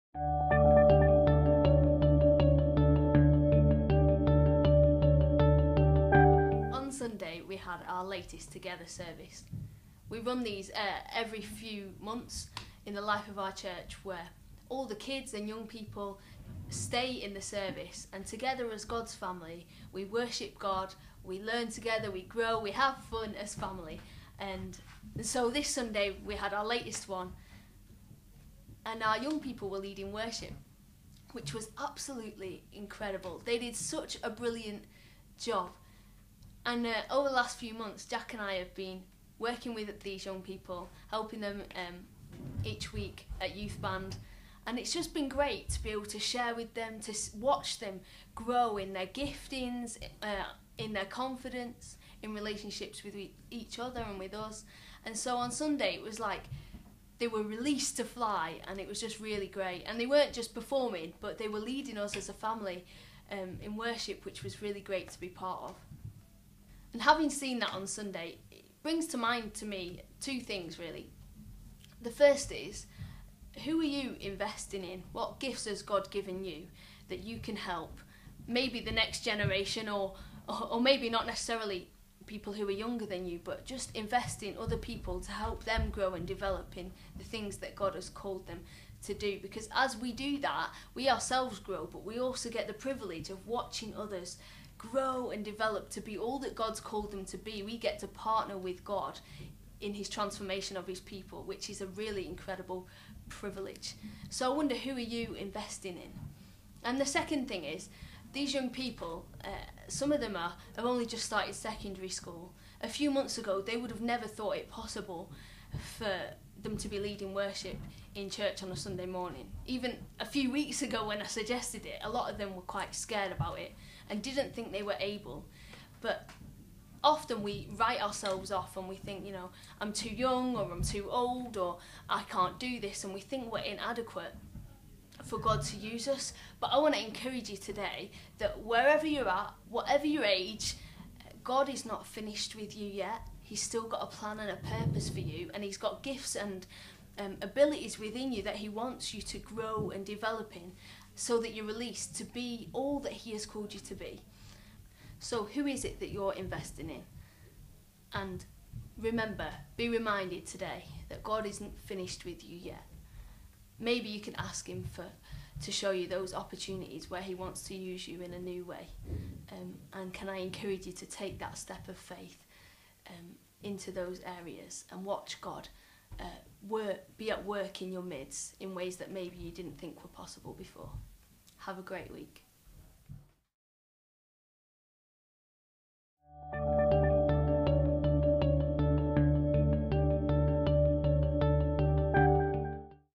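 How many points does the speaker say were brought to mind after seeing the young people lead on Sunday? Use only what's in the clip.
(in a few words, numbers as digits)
2.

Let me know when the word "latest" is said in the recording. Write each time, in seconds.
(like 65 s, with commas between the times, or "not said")
8 s, 26 s.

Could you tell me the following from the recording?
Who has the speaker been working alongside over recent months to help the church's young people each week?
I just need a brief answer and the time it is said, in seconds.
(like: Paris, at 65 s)
Jack, at 38 s.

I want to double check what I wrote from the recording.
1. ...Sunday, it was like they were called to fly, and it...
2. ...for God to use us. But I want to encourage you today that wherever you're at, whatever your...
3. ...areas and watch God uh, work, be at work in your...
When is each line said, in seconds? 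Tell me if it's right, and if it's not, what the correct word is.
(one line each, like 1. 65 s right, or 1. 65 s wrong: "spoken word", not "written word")
1. 55 s wrong: "released", not "called"
2. 135 s right
3. 174 s right.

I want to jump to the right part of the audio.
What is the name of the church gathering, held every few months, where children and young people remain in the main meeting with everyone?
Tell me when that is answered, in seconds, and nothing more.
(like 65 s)
8 s.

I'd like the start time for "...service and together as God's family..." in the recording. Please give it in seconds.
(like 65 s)
17 s.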